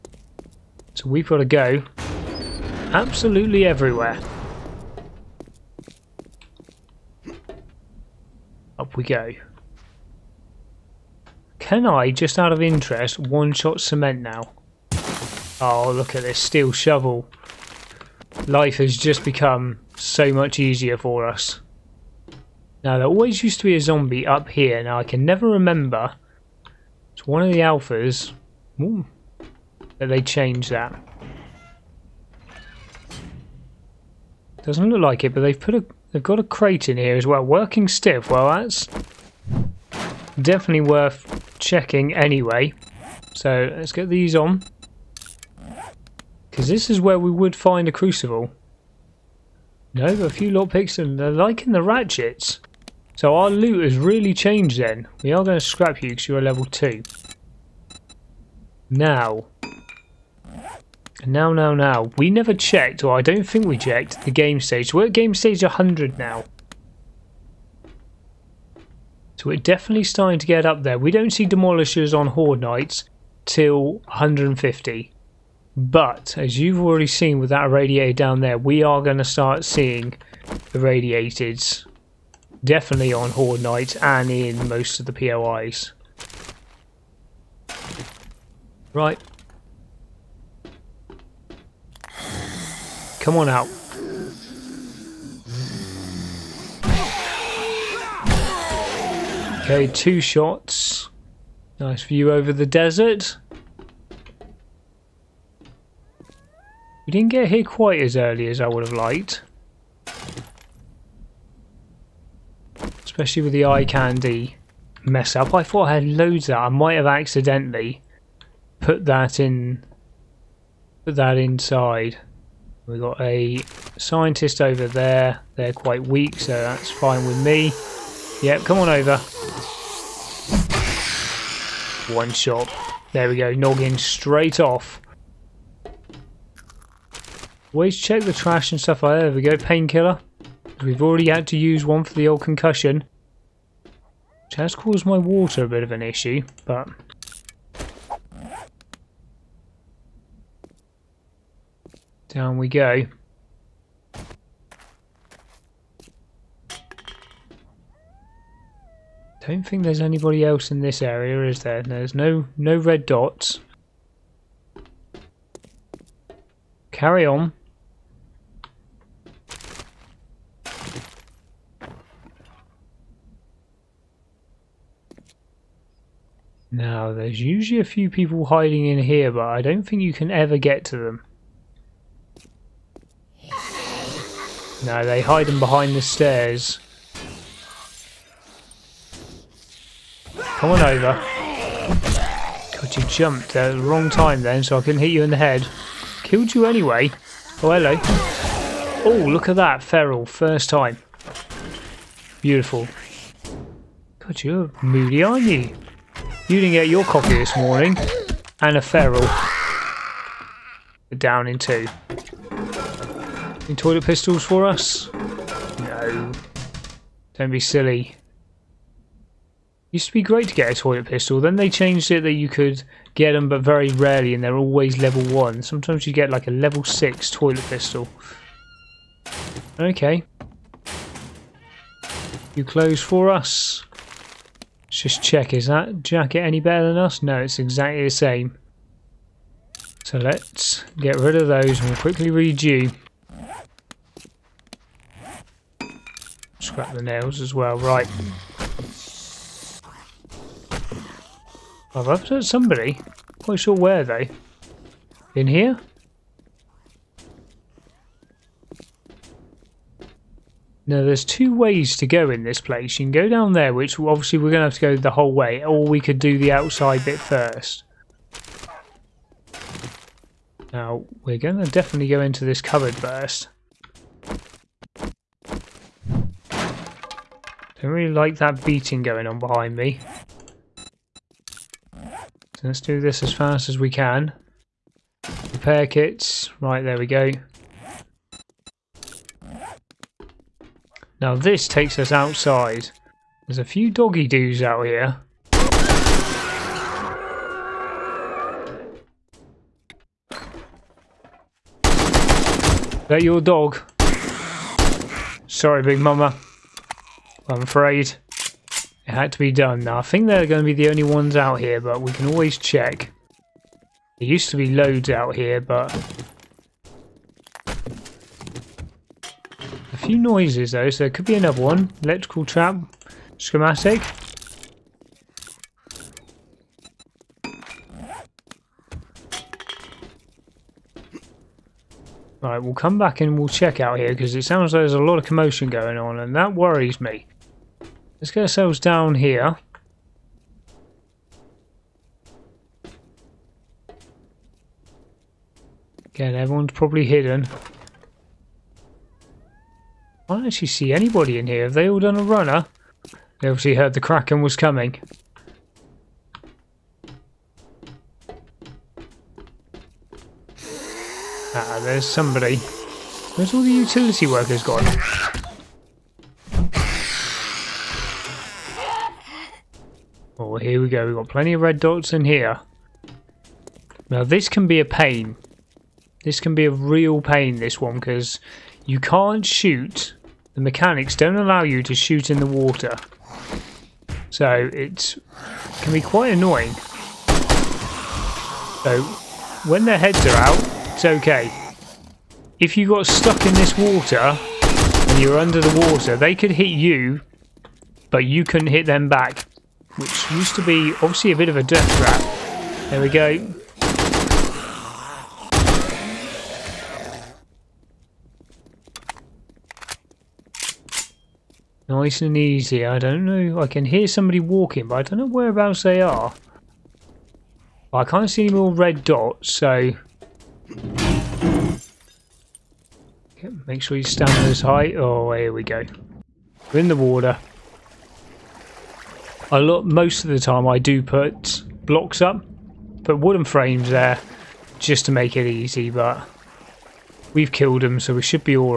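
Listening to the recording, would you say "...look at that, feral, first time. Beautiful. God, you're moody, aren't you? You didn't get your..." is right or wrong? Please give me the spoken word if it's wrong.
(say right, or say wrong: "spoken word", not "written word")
right.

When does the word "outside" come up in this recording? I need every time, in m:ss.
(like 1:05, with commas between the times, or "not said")
4:26, 4:52.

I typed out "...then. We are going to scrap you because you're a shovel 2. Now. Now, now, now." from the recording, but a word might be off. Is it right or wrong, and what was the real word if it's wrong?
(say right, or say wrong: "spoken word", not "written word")
wrong: "level", not "shovel".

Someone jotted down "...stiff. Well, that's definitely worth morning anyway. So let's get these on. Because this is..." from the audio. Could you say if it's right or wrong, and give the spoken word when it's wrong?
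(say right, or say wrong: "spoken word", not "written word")
wrong: "checking", not "morning".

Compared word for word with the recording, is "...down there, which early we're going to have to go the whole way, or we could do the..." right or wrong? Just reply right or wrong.
wrong.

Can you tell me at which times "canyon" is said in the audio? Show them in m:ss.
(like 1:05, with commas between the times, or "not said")
not said.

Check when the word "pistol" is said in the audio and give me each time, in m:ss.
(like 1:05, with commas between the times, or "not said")
3:34, 3:41, 3:47.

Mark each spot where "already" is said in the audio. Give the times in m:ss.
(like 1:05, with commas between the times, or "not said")
1:16, 2:21.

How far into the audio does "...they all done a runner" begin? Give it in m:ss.
5:51.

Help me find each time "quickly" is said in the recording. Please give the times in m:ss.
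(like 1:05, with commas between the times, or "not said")
4:01.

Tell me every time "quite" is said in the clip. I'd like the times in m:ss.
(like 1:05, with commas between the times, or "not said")
1:47, 2:05, 4:13, 6:25.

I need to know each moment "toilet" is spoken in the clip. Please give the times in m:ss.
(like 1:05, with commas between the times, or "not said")
3:33, 3:40, 3:47.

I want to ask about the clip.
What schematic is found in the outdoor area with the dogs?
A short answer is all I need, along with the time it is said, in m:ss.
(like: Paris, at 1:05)
Electrical trap, at 5:22.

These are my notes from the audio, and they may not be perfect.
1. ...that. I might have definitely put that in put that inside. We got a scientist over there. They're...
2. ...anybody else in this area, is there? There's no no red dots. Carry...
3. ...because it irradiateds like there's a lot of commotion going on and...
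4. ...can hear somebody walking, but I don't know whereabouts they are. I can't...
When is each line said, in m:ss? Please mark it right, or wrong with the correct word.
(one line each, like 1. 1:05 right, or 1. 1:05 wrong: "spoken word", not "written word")
1. 1:56 wrong: "accidentally", not "definitely"
2. 2:39 right
3. 5:34 wrong: "sounds", not "irradiateds"
4. 6:53 right.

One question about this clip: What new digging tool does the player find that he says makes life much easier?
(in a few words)
Steel shovel.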